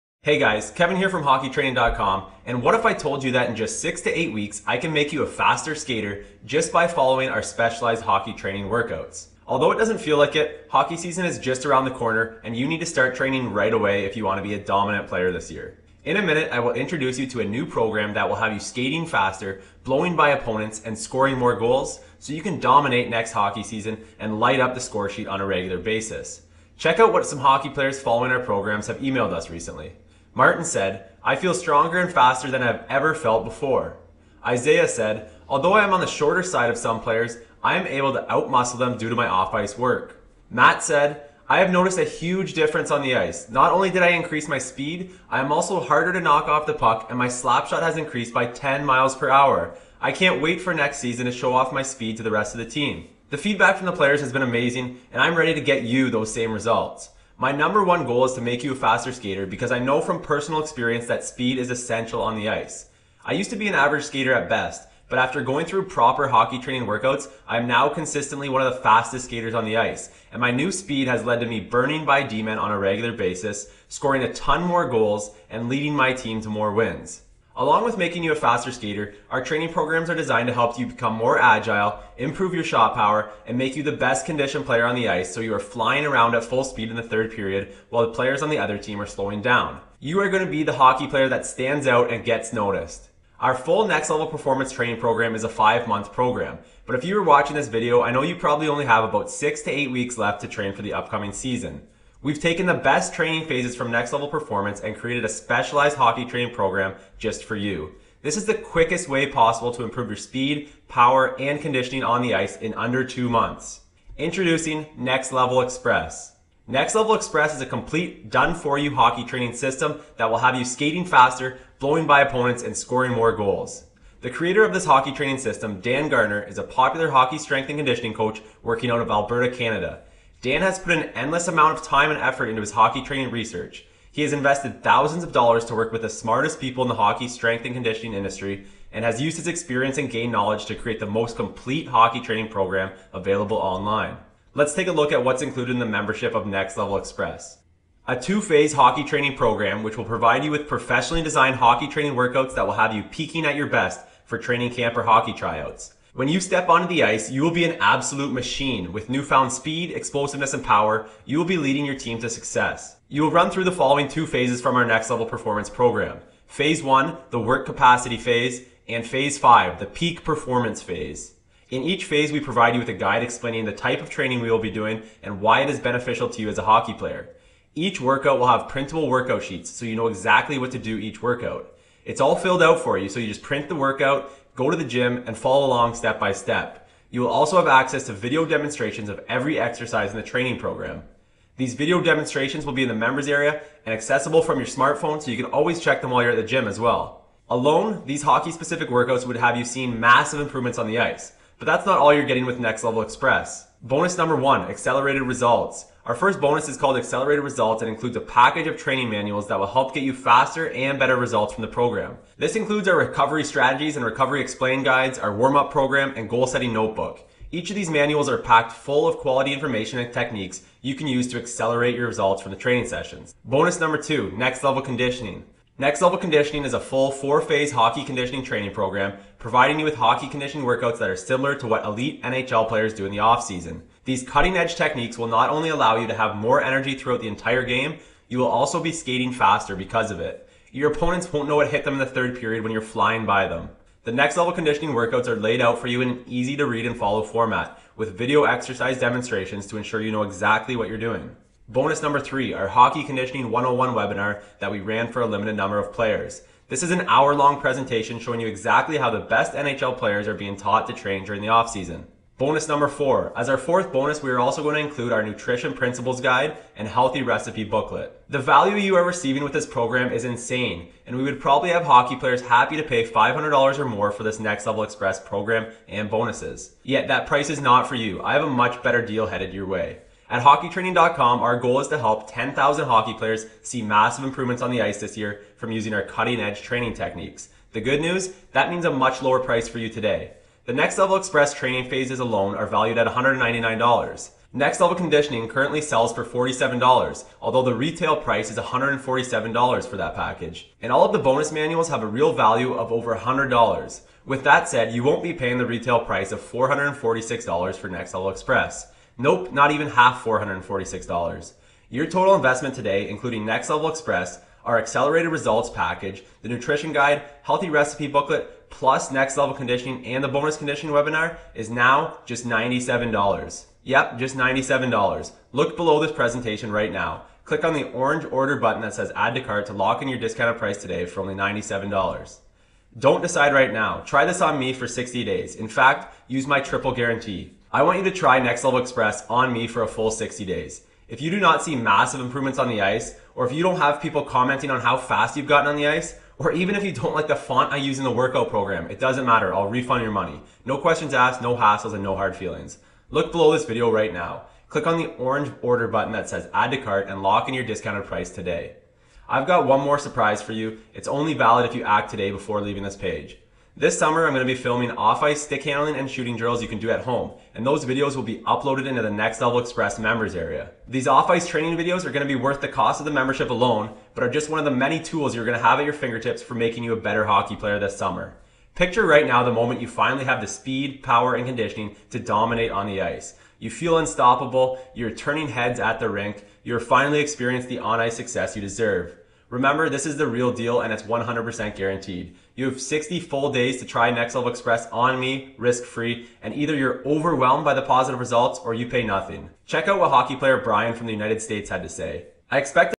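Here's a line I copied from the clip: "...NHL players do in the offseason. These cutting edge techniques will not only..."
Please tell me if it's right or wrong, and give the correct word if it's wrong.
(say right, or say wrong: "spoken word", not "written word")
right.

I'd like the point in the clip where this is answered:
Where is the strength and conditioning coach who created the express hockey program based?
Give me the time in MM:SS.
02:09.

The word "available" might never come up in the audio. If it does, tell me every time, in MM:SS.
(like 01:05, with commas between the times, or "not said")
02:23.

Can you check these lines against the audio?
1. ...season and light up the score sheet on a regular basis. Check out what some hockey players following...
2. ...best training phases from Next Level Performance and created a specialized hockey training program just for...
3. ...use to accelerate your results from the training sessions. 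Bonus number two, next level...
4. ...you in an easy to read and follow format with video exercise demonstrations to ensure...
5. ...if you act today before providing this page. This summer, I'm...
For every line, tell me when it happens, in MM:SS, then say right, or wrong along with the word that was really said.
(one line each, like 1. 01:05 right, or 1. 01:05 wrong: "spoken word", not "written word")
1. 00:23 right
2. 01:42 right
3. 03:41 right
4. 04:05 right
5. 06:01 wrong: "leaving", not "providing".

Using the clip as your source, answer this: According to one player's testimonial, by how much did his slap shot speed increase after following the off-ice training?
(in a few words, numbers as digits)
10 miles per hour.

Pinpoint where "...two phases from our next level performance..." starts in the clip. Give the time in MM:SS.
02:44.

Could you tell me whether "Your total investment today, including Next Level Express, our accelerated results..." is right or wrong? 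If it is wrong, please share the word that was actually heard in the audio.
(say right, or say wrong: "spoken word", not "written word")
right.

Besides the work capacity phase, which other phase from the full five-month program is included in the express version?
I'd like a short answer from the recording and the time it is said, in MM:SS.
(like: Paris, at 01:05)
peak performance phase, at 02:49.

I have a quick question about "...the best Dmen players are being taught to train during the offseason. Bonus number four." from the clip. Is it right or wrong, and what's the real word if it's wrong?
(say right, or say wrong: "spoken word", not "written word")
wrong: "NHL", not "Dmen".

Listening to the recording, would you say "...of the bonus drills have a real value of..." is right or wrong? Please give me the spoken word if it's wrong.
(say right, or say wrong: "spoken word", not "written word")
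wrong: "manuals", not "drills".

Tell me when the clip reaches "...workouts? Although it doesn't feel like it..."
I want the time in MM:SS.
00:08.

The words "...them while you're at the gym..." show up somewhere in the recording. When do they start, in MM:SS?
03:16.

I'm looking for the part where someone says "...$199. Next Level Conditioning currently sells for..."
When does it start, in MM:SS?
04:53.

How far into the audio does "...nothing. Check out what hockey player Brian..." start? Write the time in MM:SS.
06:39.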